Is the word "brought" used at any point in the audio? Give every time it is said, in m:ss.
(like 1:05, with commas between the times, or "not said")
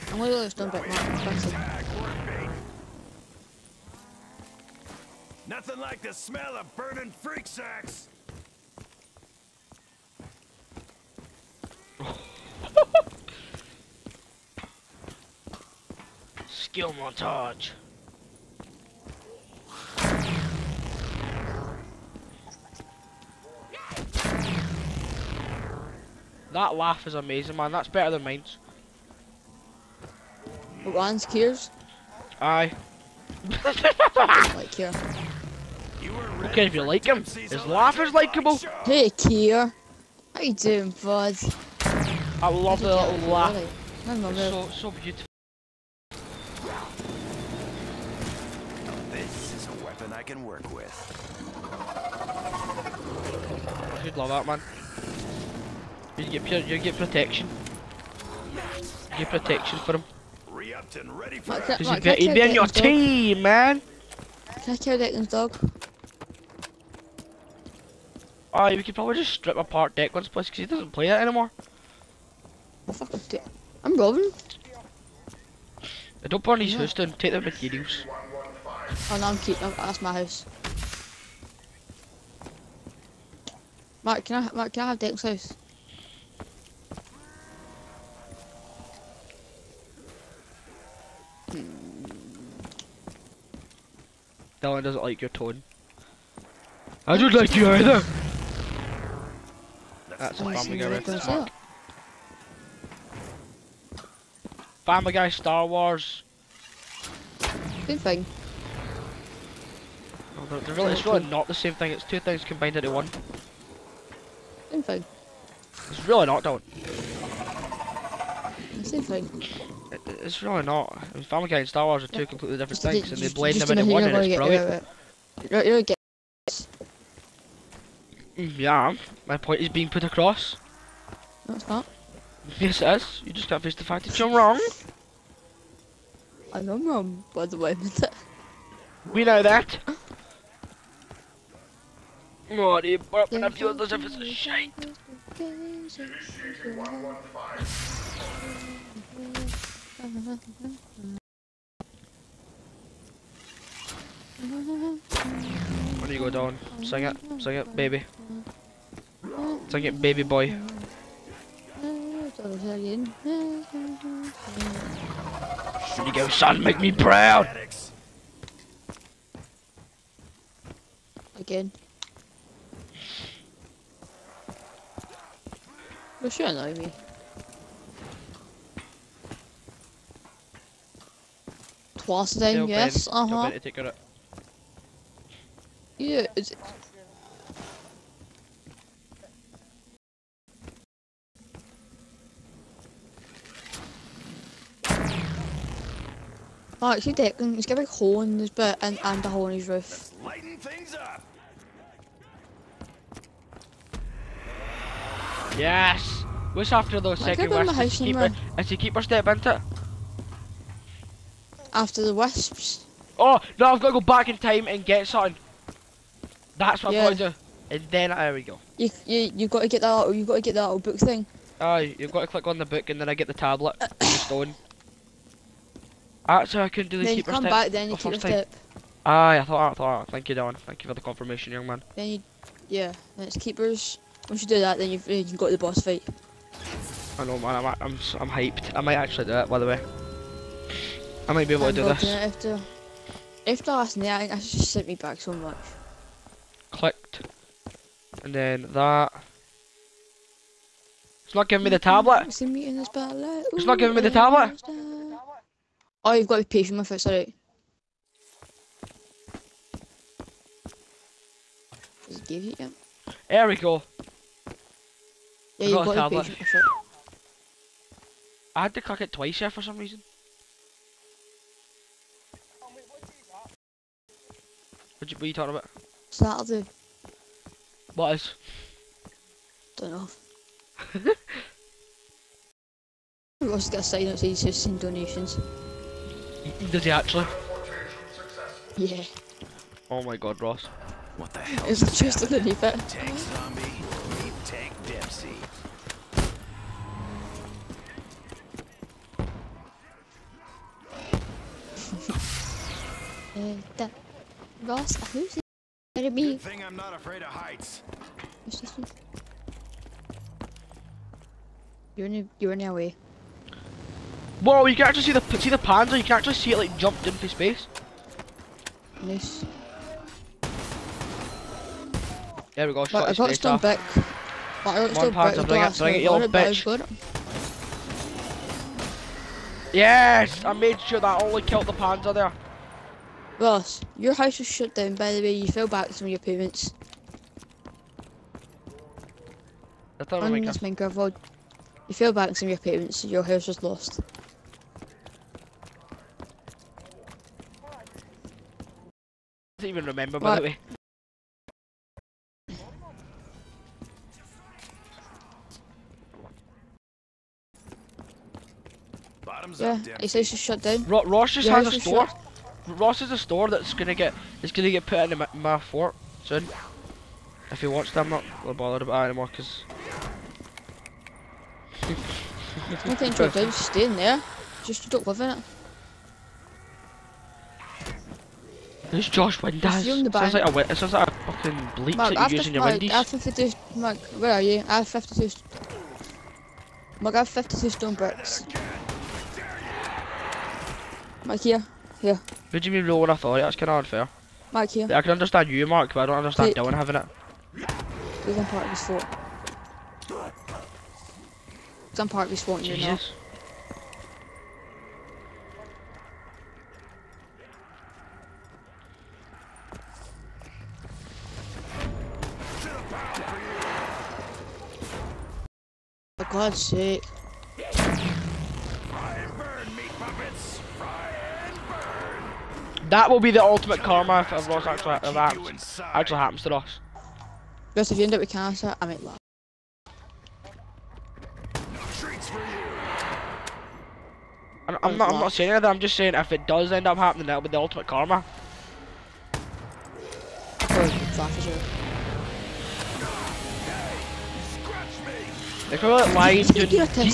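2:22.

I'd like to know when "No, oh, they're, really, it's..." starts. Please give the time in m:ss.
1:50.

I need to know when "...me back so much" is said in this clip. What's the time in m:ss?
4:04.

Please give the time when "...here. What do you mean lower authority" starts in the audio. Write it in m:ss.
6:32.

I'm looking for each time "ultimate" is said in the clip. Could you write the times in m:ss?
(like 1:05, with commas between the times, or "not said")
7:03, 7:17.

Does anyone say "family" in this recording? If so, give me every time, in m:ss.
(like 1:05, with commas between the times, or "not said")
1:40, 1:44, 2:01.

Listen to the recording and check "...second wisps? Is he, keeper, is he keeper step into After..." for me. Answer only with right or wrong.
right.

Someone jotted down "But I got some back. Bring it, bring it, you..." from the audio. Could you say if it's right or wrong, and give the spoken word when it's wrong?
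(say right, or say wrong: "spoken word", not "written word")
right.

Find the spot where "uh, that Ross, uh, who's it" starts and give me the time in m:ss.
5:03.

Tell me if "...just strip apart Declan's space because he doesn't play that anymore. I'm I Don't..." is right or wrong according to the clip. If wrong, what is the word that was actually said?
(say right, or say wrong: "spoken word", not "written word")
wrong: "place", not "space".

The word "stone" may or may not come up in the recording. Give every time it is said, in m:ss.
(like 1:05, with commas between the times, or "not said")
0:00, 3:44, 6:27.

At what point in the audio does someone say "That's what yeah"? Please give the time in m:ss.
3:36.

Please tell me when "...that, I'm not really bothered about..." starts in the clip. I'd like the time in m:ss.
6:07.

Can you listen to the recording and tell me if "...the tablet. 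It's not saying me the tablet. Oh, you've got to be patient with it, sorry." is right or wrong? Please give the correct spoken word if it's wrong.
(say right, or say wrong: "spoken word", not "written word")
wrong: "giving", not "saying".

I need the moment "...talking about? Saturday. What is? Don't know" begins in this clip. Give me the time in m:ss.
4:35.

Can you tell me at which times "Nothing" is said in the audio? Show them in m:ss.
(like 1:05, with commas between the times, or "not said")
0:05, 6:12.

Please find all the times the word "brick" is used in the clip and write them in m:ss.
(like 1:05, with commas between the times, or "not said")
0:00, 6:27.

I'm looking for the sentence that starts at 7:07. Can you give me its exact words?
Because if you end up with cancer, I might laugh.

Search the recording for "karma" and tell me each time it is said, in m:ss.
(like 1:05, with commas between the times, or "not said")
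7:03, 7:17.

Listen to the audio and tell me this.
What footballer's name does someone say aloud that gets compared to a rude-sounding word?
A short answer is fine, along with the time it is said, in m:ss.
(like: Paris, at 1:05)
Josh Windass, at 6:19.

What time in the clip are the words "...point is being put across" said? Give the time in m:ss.
2:09.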